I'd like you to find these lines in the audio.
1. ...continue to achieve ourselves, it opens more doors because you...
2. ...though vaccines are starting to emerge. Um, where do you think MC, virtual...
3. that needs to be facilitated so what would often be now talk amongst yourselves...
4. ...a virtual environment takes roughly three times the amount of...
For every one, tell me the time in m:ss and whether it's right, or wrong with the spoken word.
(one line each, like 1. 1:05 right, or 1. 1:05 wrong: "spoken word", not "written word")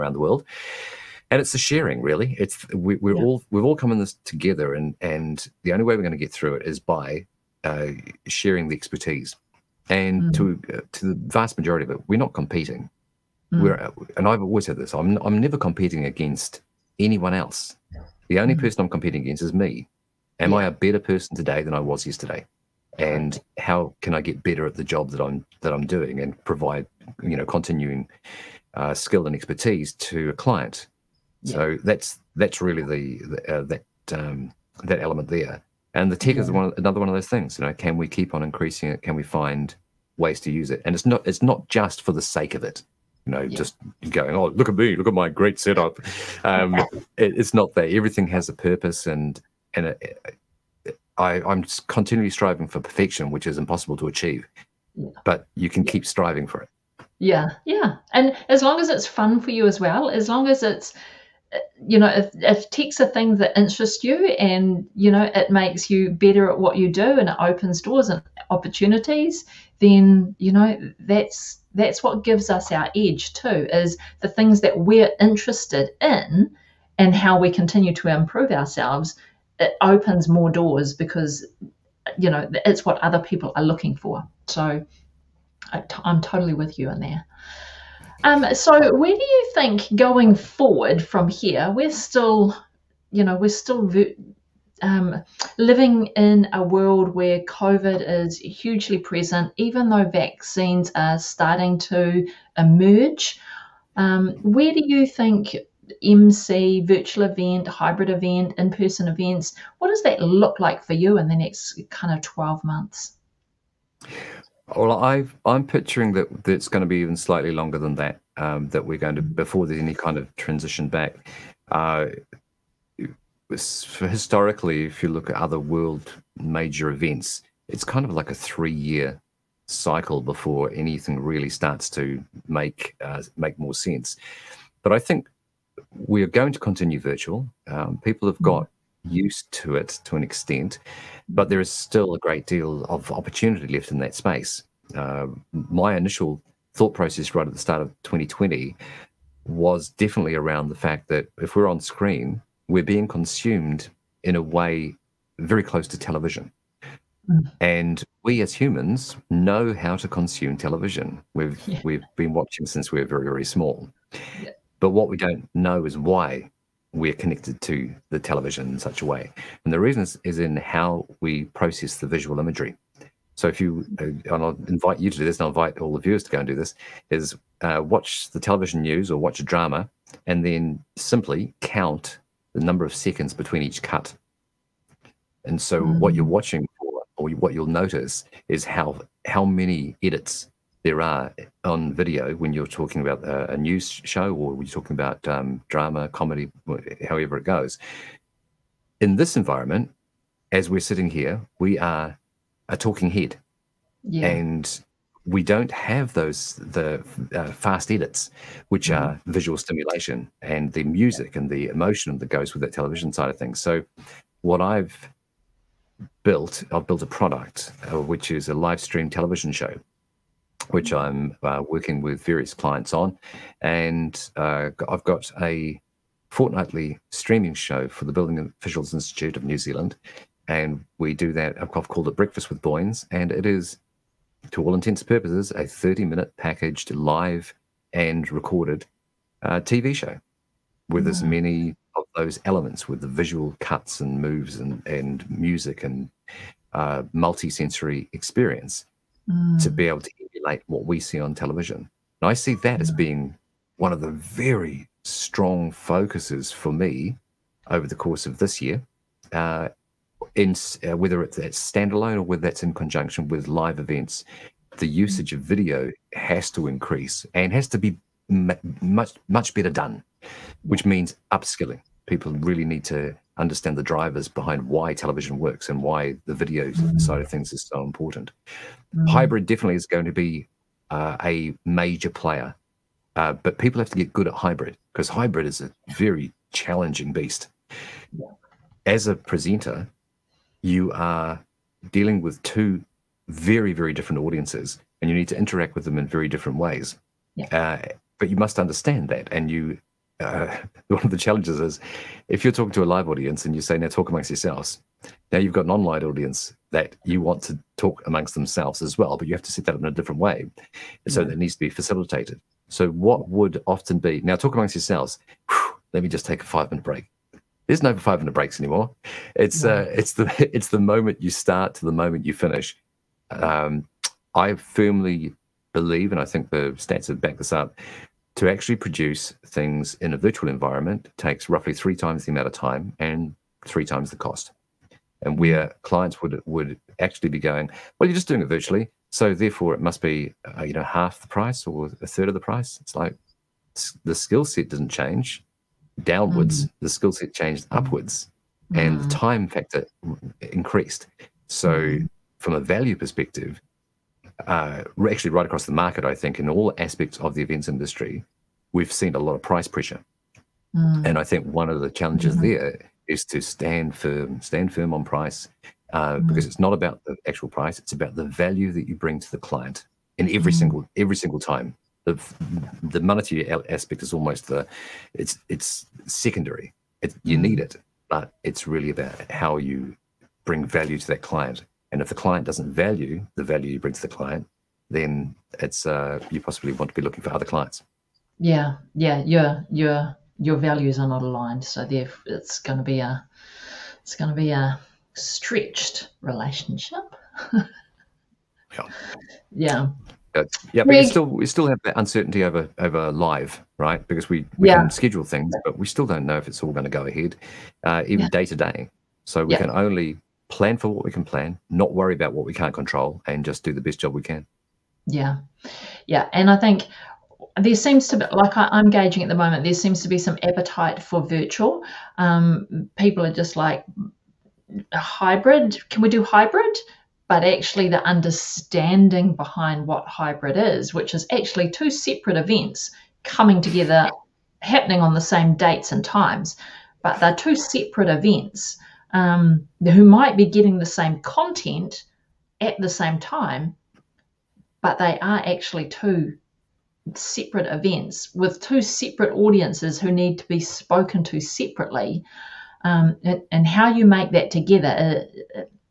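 1. 1:17 wrong: "improve", not "achieve"
2. 1:39 right
3. 5:11 right
4. 5:30 right.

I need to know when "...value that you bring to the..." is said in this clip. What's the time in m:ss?
6:08.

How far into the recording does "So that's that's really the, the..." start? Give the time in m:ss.
0:31.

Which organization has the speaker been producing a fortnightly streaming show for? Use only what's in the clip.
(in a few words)
Building Officials Institute of New Zealand.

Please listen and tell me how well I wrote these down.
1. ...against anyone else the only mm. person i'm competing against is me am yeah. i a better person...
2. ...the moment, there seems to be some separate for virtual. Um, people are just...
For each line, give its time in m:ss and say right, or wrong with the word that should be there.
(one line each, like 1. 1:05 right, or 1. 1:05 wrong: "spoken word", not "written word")
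1. 0:16 right
2. 6:59 wrong: "appetite", not "separate".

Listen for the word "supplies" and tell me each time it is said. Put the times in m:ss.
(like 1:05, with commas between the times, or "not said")
not said.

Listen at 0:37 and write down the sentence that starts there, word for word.
You know, can we keep on increasing it?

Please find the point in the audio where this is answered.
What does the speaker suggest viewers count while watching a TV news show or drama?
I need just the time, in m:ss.
3:02.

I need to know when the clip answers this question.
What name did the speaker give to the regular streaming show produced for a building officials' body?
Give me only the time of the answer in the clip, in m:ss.
3:52.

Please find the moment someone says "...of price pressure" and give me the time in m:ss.
5:59.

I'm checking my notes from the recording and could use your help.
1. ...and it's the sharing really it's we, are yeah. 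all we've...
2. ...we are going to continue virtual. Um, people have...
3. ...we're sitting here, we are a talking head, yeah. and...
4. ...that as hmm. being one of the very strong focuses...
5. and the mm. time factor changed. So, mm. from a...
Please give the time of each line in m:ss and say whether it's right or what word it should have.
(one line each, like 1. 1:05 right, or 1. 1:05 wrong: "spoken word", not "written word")
1. 0:01 right
2. 2:15 right
3. 3:20 right
4. 4:12 right
5. 5:48 wrong: "increased", not "changed".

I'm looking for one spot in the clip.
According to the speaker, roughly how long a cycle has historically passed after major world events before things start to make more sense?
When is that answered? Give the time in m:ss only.
2:08.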